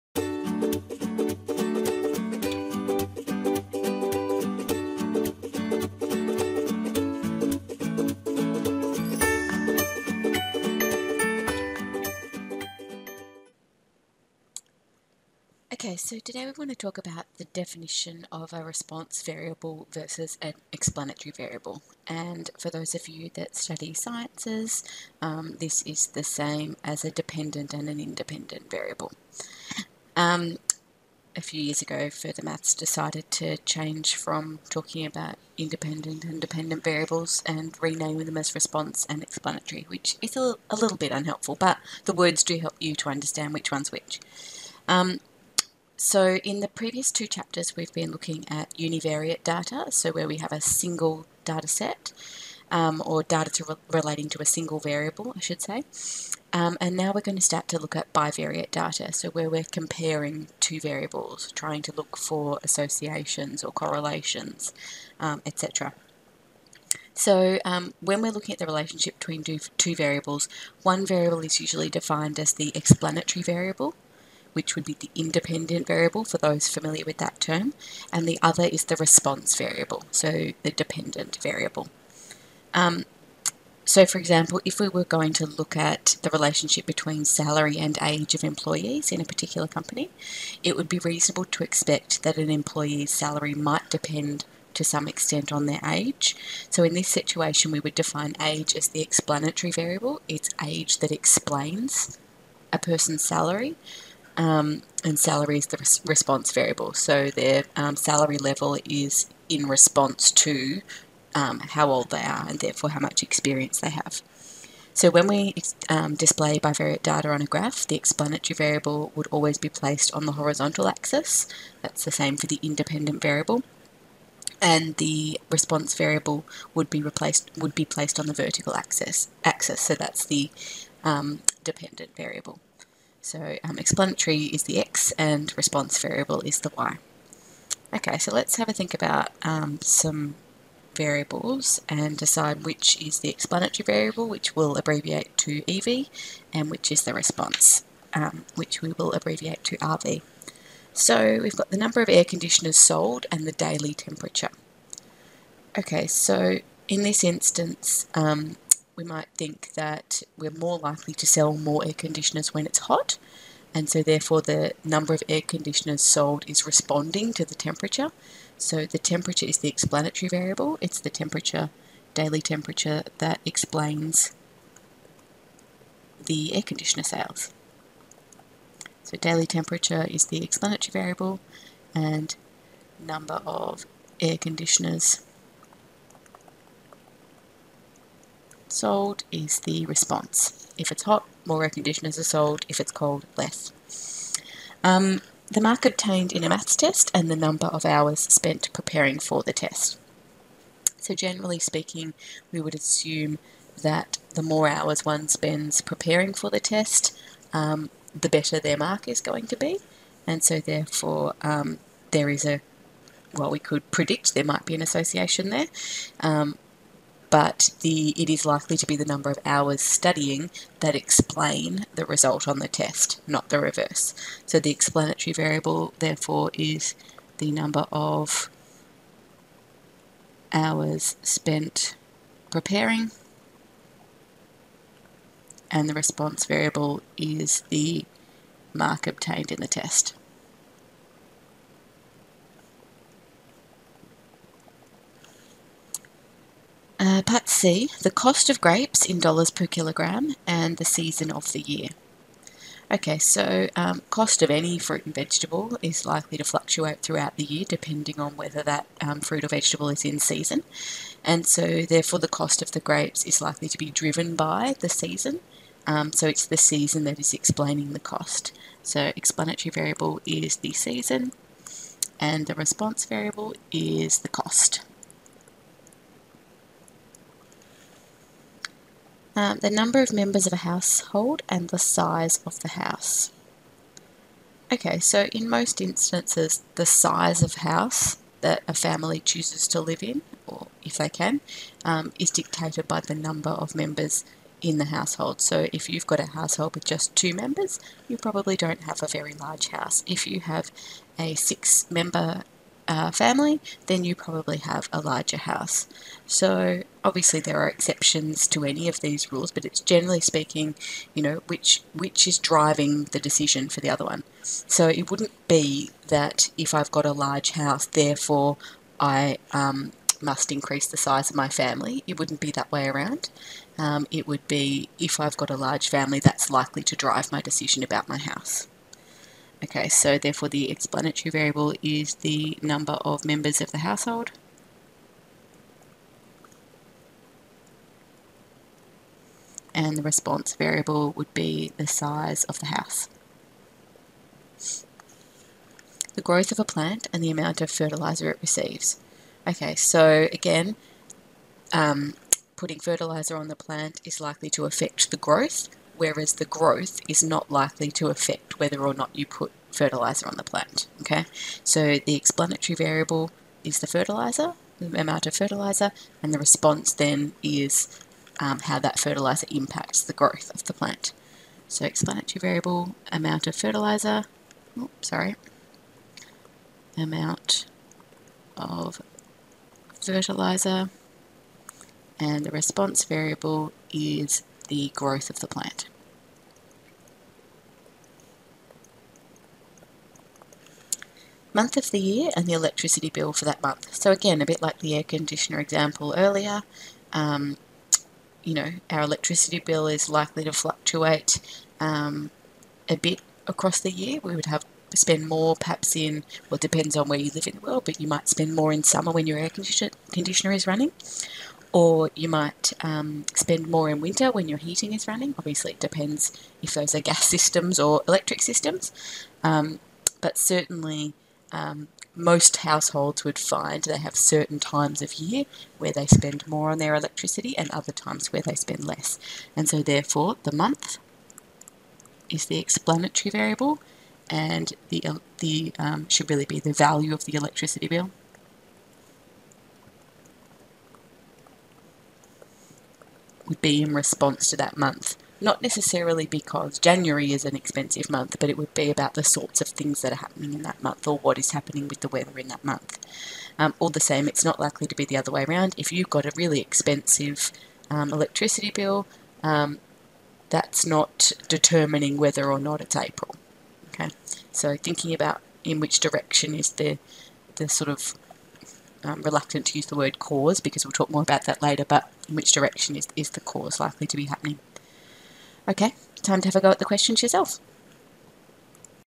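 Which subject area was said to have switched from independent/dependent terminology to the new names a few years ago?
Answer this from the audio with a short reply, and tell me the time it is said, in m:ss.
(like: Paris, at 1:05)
further maths, at 0:32.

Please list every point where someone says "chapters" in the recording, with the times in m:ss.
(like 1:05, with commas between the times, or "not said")
0:47.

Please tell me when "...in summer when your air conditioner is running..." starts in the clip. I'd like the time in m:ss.
6:48.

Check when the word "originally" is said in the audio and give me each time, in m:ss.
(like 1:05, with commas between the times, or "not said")
not said.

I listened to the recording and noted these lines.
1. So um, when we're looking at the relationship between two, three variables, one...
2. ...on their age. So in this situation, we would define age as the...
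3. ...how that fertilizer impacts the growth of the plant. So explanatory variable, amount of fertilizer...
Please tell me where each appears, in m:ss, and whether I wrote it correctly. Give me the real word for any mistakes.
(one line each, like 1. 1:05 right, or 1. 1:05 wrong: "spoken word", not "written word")
1. 1:07 wrong: "two", not "three"
2. 1:35 right
3. 6:08 right.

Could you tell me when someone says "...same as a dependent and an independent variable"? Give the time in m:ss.
0:26.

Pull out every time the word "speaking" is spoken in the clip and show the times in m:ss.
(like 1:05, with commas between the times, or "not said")
3:21, 5:10.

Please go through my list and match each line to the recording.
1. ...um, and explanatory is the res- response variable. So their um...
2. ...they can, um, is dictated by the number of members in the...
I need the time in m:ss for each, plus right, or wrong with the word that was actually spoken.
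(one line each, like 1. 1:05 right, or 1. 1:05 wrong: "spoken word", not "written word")
1. 1:44 wrong: "salary", not "explanatory"
2. 4:50 right.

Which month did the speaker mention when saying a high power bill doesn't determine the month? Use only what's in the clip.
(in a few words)
April.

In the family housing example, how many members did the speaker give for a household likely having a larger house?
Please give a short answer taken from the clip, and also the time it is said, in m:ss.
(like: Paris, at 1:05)
6, at 5:01.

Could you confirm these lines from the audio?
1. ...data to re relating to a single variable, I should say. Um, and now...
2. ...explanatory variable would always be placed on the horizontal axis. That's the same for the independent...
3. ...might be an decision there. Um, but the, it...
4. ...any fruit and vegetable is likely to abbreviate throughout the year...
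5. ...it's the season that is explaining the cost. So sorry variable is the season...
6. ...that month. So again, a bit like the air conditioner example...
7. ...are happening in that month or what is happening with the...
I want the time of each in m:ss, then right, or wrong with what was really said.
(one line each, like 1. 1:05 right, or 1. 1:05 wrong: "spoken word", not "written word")
1. 0:53 right
2. 1:57 right
3. 3:34 wrong: "association", not "decision"
4. 4:14 wrong: "fluctuate", not "abbreviate"
5. 4:26 wrong: "explanatory", not "sorry"
6. 6:33 right
7. 7:30 right.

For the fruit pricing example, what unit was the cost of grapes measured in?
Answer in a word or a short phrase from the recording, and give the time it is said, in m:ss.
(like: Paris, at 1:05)
dollars per kilogram, at 4:09.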